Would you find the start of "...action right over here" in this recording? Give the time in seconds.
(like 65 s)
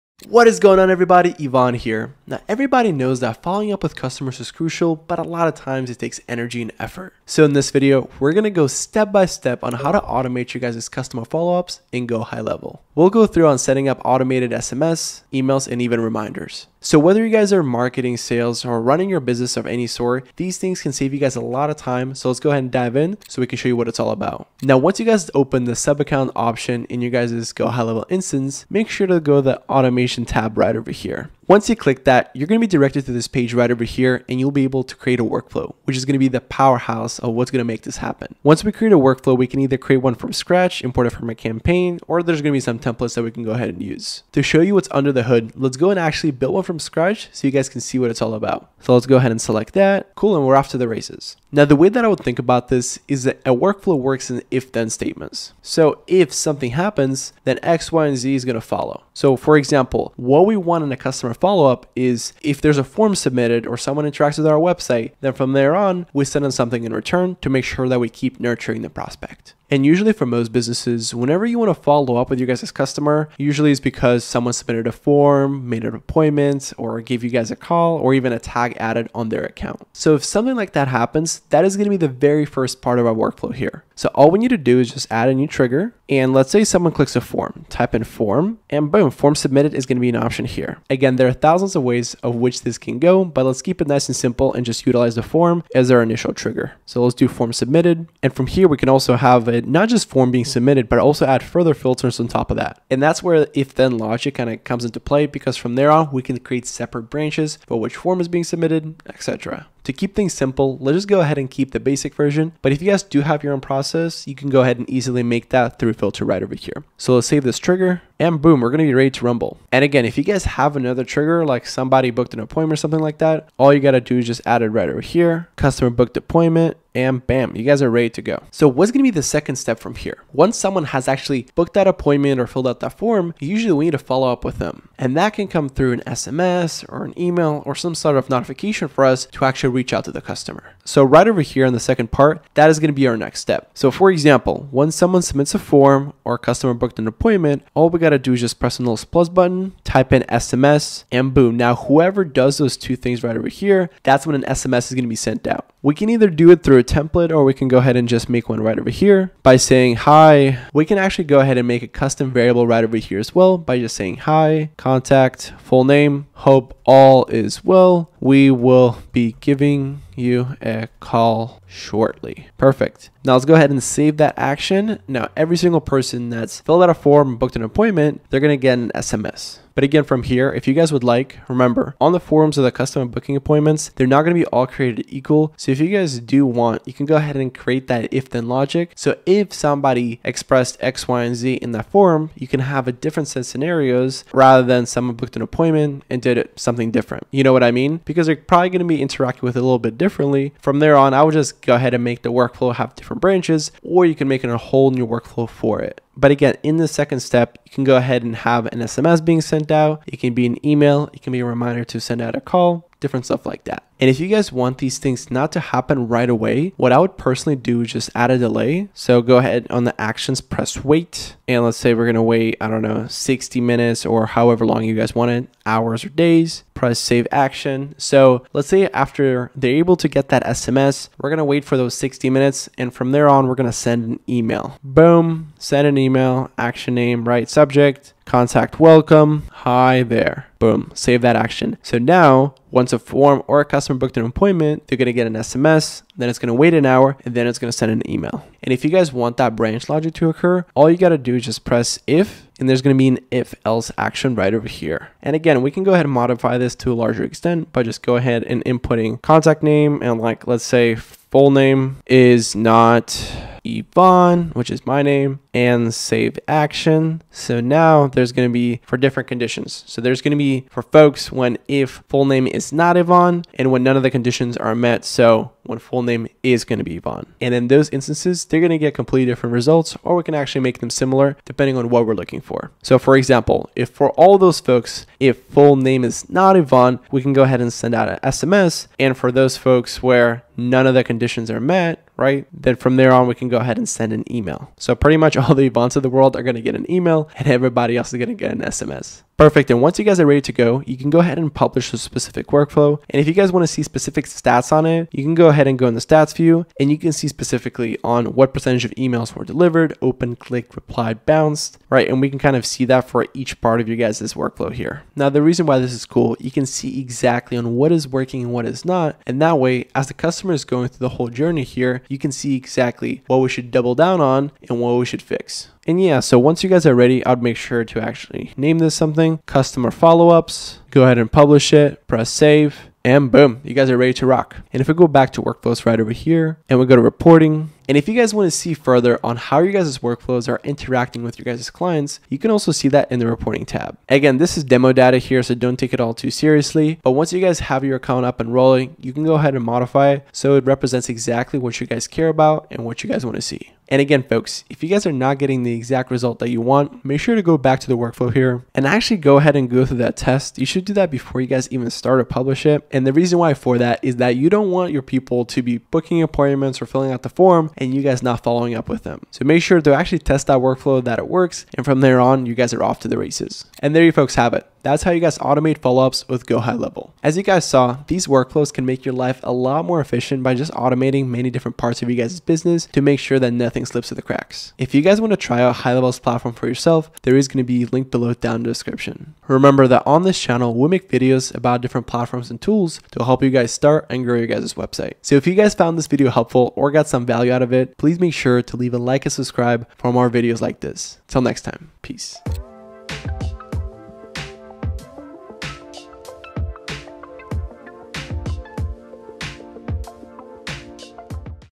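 253 s.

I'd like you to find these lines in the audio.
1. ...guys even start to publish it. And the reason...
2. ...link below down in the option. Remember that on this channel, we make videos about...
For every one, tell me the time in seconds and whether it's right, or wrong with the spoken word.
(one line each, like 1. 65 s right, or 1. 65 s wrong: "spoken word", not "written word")
1. 361 s right
2. 387 s wrong: "description", not "option".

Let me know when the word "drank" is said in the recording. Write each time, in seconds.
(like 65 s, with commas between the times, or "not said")
not said.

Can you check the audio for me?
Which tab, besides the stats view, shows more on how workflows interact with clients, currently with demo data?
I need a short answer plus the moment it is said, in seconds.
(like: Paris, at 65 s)
Reporting tab, at 343 s.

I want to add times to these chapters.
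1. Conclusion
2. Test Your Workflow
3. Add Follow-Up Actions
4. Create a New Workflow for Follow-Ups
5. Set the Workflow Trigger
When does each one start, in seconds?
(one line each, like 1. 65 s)
1. 373 s
2. 299 s
3. 140 s
4. 24 s
5. 49 s.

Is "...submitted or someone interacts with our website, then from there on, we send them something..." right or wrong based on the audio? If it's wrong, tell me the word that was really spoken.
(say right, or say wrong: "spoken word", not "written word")
right.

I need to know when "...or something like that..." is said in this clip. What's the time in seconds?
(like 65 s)
122 s.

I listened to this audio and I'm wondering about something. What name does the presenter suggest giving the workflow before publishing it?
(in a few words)
Testing, customer follow ups.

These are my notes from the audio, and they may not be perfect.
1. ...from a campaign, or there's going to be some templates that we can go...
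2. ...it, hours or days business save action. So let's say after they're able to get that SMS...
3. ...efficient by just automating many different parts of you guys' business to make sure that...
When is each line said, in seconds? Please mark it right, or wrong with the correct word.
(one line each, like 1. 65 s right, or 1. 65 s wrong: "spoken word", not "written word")
1. 41 s right
2. 225 s wrong: "press", not "business"
3. 380 s right.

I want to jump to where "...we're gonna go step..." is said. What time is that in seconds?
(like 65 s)
8 s.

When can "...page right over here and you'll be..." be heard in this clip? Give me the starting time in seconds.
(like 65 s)
33 s.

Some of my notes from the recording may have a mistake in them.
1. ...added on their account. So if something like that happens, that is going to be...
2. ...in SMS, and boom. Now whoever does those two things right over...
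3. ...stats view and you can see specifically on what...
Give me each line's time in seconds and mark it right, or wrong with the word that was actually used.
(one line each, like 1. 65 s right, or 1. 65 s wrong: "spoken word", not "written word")
1. 78 s right
2. 150 s right
3. 305 s right.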